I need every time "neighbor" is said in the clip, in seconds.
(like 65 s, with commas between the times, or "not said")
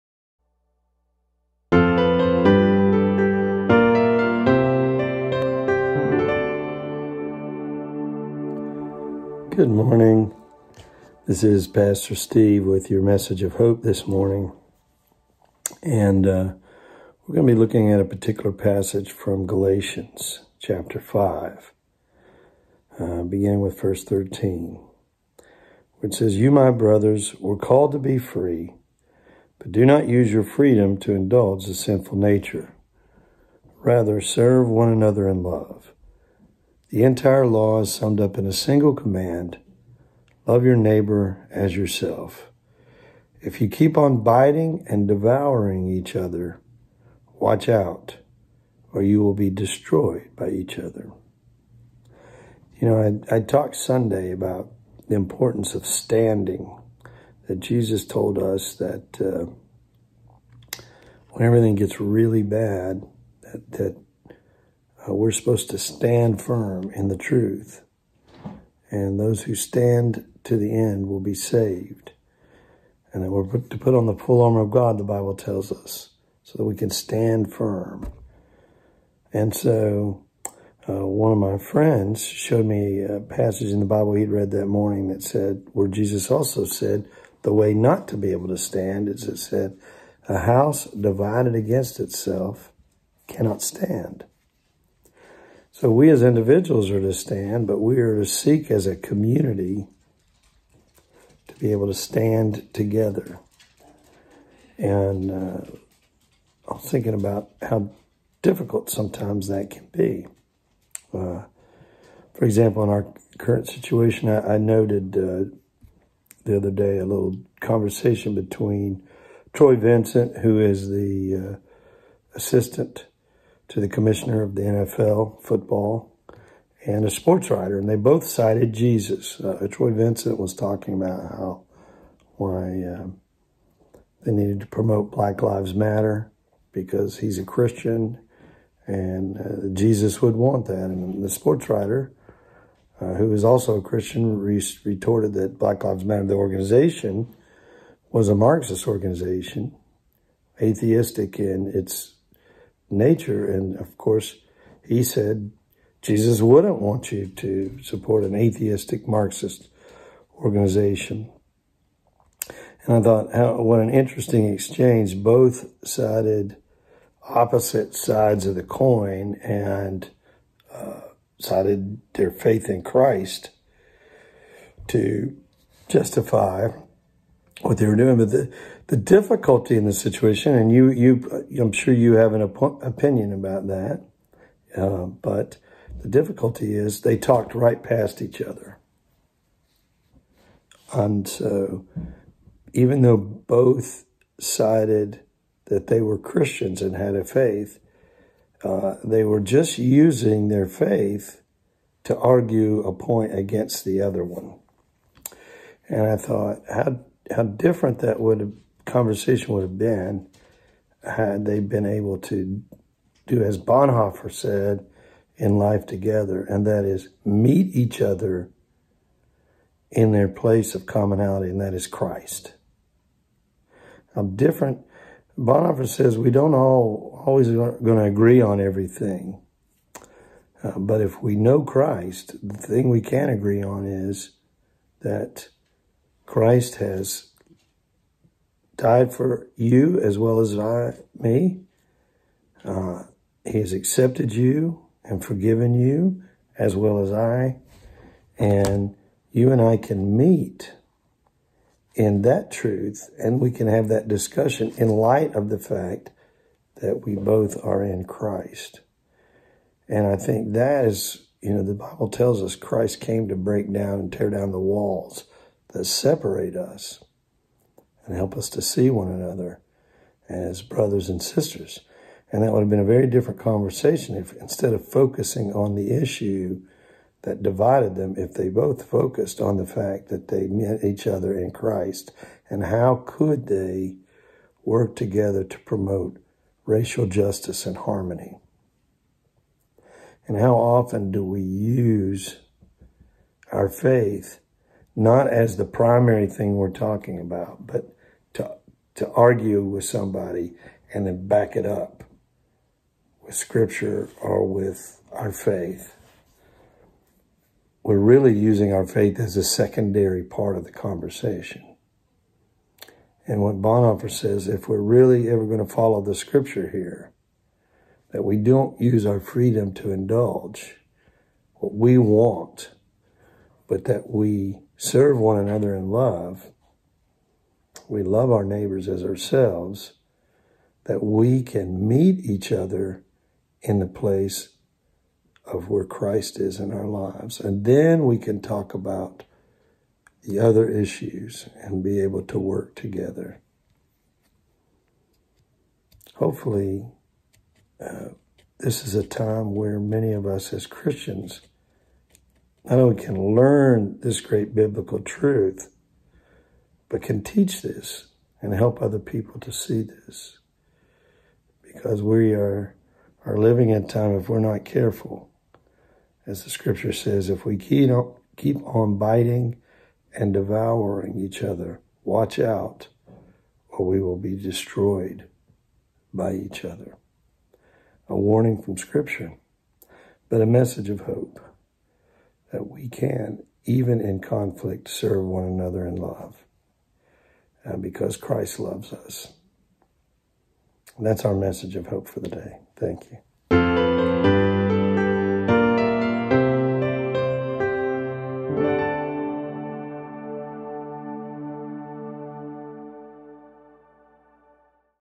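40 s, 328 s.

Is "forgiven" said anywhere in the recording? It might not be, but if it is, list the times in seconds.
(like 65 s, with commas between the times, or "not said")
245 s.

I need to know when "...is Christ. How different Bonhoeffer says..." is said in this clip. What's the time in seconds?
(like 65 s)
221 s.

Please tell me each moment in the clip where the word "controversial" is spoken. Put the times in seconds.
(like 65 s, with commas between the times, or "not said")
not said.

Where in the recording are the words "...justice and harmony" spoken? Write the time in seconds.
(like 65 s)
287 s.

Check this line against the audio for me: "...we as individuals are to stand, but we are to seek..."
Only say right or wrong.
right.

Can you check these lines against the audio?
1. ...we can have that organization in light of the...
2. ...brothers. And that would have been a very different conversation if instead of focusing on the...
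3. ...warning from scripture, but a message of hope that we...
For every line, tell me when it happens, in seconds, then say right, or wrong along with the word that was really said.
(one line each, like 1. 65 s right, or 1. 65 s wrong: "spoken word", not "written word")
1. 253 s wrong: "discussion", not "organization"
2. 271 s wrong: "sisters", not "brothers"
3. 378 s right.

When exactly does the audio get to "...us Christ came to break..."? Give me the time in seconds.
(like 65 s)
262 s.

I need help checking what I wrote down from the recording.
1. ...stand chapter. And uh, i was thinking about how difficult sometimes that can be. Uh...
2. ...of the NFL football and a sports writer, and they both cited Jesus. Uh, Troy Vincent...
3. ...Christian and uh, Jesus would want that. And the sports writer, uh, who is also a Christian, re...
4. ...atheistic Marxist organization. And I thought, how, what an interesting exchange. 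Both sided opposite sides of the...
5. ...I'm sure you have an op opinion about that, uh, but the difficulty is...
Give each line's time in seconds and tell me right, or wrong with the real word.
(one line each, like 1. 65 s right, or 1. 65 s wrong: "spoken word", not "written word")
1. 101 s wrong: "together", not "chapter"
2. 124 s right
3. 137 s right
4. 158 s right
5. 181 s right.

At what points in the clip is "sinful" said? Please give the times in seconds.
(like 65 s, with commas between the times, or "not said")
31 s.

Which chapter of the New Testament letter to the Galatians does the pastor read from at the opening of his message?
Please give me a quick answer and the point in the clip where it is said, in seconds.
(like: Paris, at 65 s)
5, at 19 s.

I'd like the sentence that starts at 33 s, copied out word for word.
Rather, serve one another in love.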